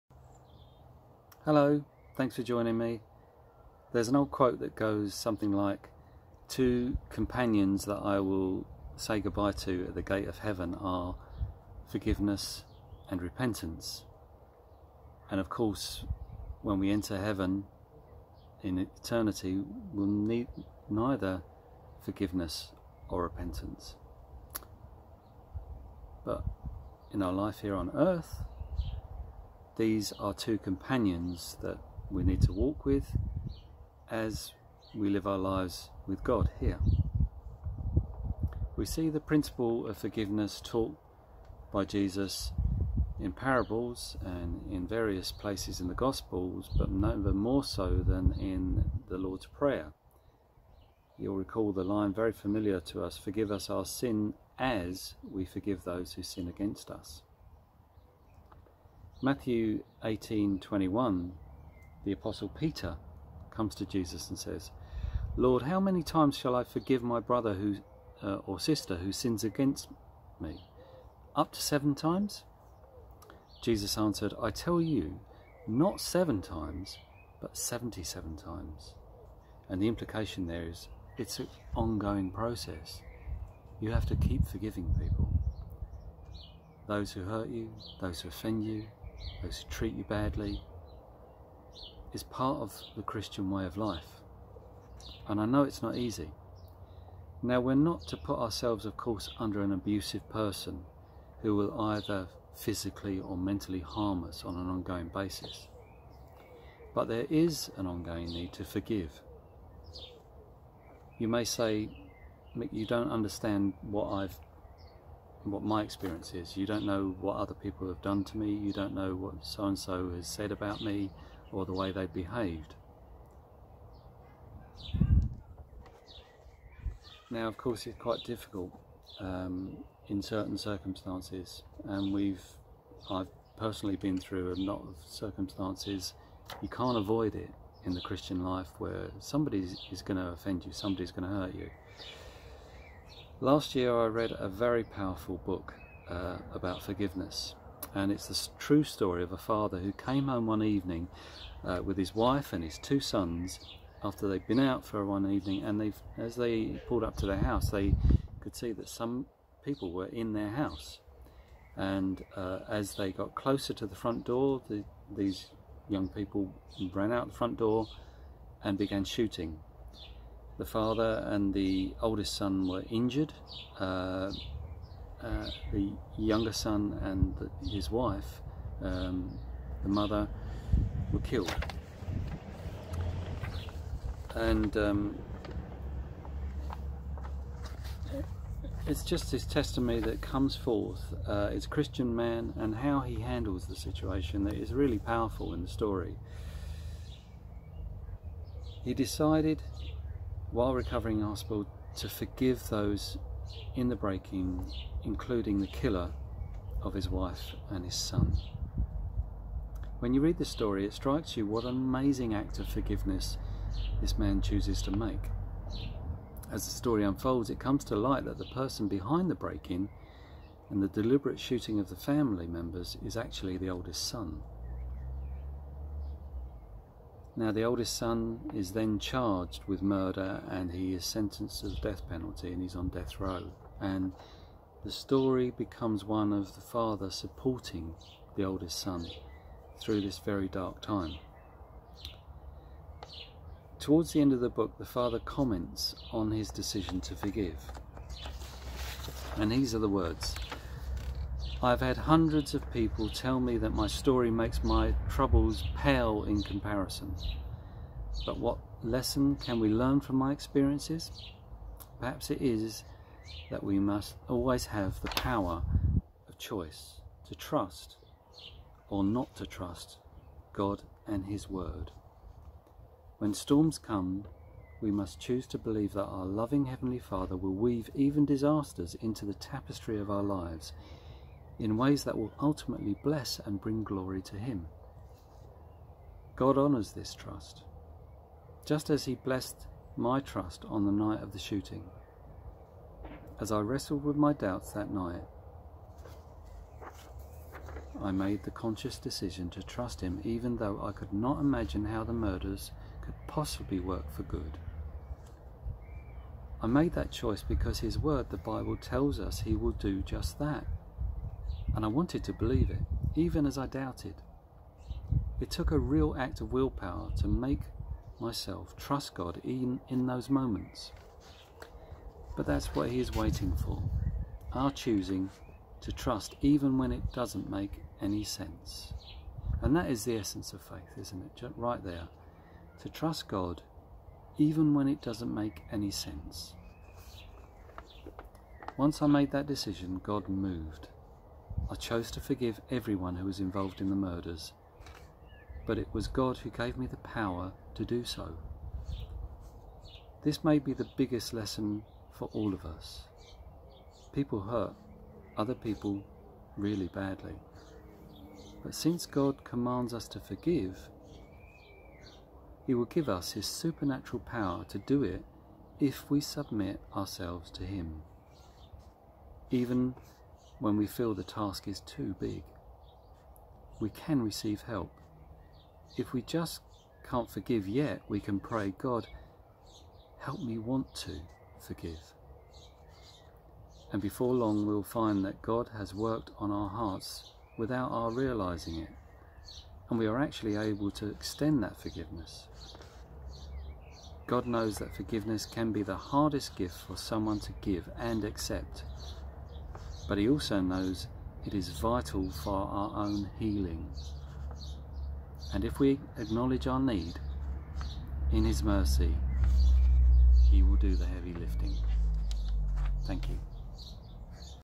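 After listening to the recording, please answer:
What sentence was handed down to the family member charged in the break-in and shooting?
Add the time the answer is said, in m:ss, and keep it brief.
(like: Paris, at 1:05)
death penalty, at 3:51.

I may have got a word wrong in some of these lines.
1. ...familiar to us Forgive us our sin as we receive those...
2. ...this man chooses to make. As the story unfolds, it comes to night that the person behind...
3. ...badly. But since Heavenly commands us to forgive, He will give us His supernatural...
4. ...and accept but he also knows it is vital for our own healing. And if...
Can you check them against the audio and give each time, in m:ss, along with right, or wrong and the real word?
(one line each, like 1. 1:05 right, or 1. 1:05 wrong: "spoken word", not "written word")
1. 0:52 wrong: "forgive", not "receive"
2. 3:34 wrong: "light", not "night"
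3. 5:56 wrong: "God", not "Heavenly"
4. 6:37 right.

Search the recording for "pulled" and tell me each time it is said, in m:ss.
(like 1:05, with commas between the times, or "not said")
2:36.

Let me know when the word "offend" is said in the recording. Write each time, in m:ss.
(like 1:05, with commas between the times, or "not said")
1:28, 2:20.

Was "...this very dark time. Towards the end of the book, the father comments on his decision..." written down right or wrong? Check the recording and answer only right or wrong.
right.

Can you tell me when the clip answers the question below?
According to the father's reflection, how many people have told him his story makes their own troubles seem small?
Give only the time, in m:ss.
4:11.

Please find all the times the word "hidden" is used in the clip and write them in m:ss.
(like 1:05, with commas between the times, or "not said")
not said.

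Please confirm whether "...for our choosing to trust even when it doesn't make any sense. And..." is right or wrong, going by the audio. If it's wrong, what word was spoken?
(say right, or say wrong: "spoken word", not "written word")
right.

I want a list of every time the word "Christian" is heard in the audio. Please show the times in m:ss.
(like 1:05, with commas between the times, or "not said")
1:33, 2:18, 3:11.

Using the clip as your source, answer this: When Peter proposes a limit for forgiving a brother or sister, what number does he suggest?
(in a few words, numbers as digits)
7.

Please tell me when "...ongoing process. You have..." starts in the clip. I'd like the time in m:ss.
1:21.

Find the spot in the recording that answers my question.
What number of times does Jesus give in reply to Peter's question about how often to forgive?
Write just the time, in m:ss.
1:17.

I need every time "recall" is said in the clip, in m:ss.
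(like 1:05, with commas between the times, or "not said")
0:51.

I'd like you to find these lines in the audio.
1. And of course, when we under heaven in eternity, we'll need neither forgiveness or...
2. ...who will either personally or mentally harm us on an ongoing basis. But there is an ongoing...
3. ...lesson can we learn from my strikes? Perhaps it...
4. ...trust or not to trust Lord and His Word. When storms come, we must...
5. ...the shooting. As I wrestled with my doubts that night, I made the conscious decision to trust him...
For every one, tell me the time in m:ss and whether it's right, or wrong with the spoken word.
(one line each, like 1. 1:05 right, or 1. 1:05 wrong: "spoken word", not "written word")
1. 0:15 wrong: "enter", not "under"
2. 1:41 wrong: "physically", not "personally"
3. 4:18 wrong: "experiences", not "strikes"
4. 4:27 wrong: "God", not "Lord"
5. 4:51 right.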